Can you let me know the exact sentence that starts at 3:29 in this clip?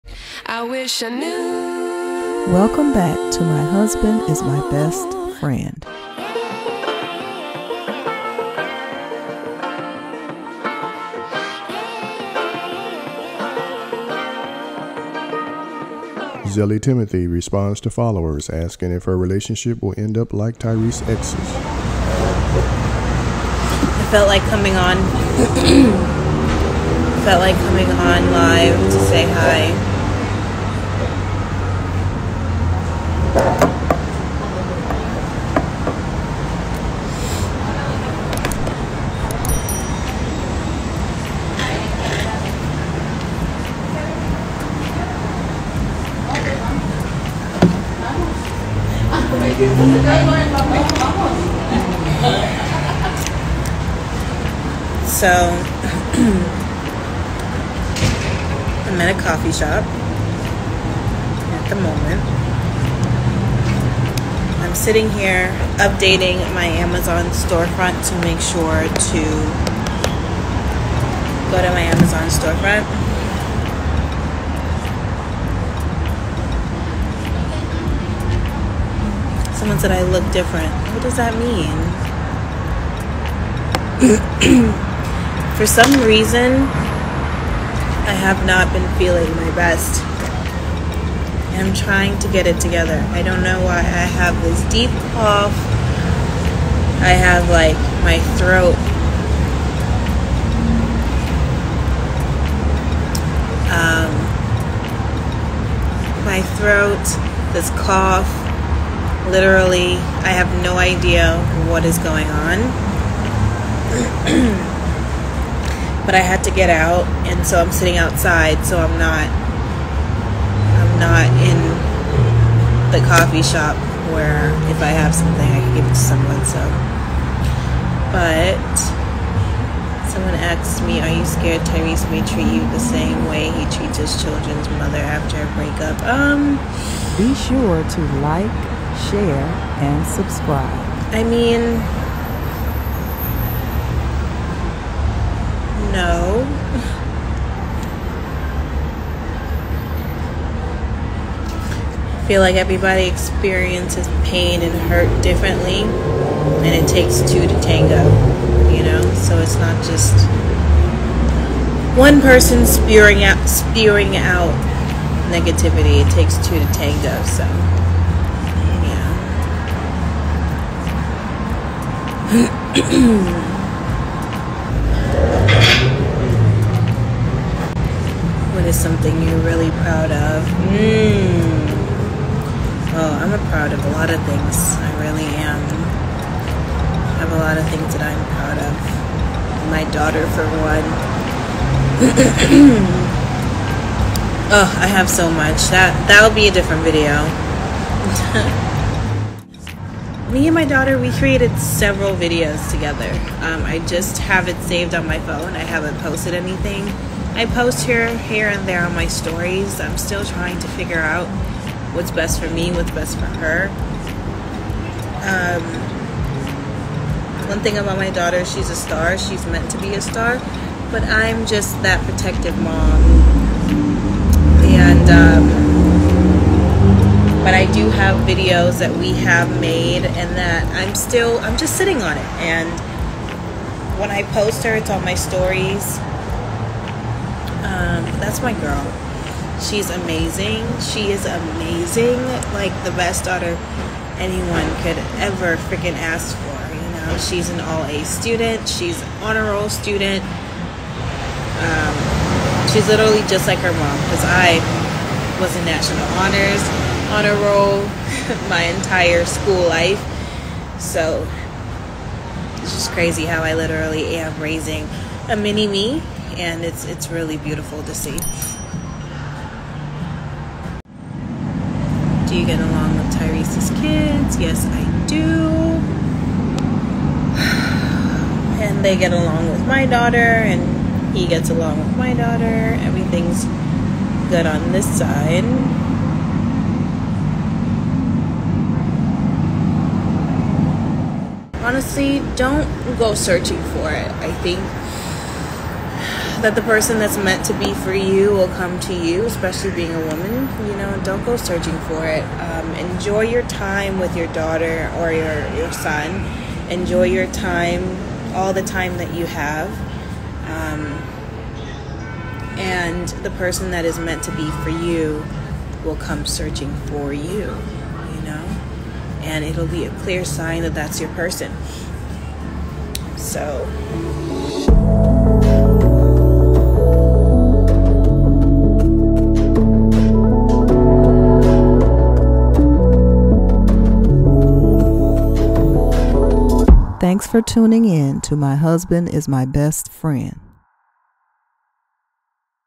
I'm still trying to figure out what's best for me, what's best for her.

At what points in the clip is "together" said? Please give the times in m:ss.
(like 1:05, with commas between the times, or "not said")
1:32, 3:22.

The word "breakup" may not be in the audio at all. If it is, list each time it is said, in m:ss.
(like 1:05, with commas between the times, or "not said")
2:15.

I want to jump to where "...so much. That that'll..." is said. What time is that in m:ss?
3:15.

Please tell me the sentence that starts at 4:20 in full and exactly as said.
So it's just crazy how I literally am raising a mini me and it's it's really beautiful to see.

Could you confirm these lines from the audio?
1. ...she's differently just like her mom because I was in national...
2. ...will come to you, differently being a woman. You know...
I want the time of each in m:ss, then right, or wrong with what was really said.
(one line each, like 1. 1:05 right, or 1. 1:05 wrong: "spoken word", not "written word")
1. 4:12 wrong: "literally", not "differently"
2. 4:58 wrong: "especially", not "differently".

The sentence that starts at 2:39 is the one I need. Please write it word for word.
So it's not just one person spewing out, spewing out negativity.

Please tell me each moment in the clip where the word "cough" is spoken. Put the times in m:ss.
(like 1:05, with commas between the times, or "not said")
1:35, 1:47.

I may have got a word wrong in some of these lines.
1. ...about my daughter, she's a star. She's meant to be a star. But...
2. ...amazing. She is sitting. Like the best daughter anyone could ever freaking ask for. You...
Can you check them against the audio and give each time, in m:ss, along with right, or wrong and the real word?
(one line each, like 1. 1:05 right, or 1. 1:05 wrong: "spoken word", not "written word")
1. 3:37 right
2. 3:59 wrong: "amazing", not "sitting".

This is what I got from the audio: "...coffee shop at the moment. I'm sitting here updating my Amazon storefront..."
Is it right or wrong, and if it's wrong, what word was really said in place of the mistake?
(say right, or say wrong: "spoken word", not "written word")
right.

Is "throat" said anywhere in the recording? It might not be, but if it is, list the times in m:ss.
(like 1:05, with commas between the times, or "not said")
1:38, 1:46.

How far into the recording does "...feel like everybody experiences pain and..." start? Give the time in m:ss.
2:32.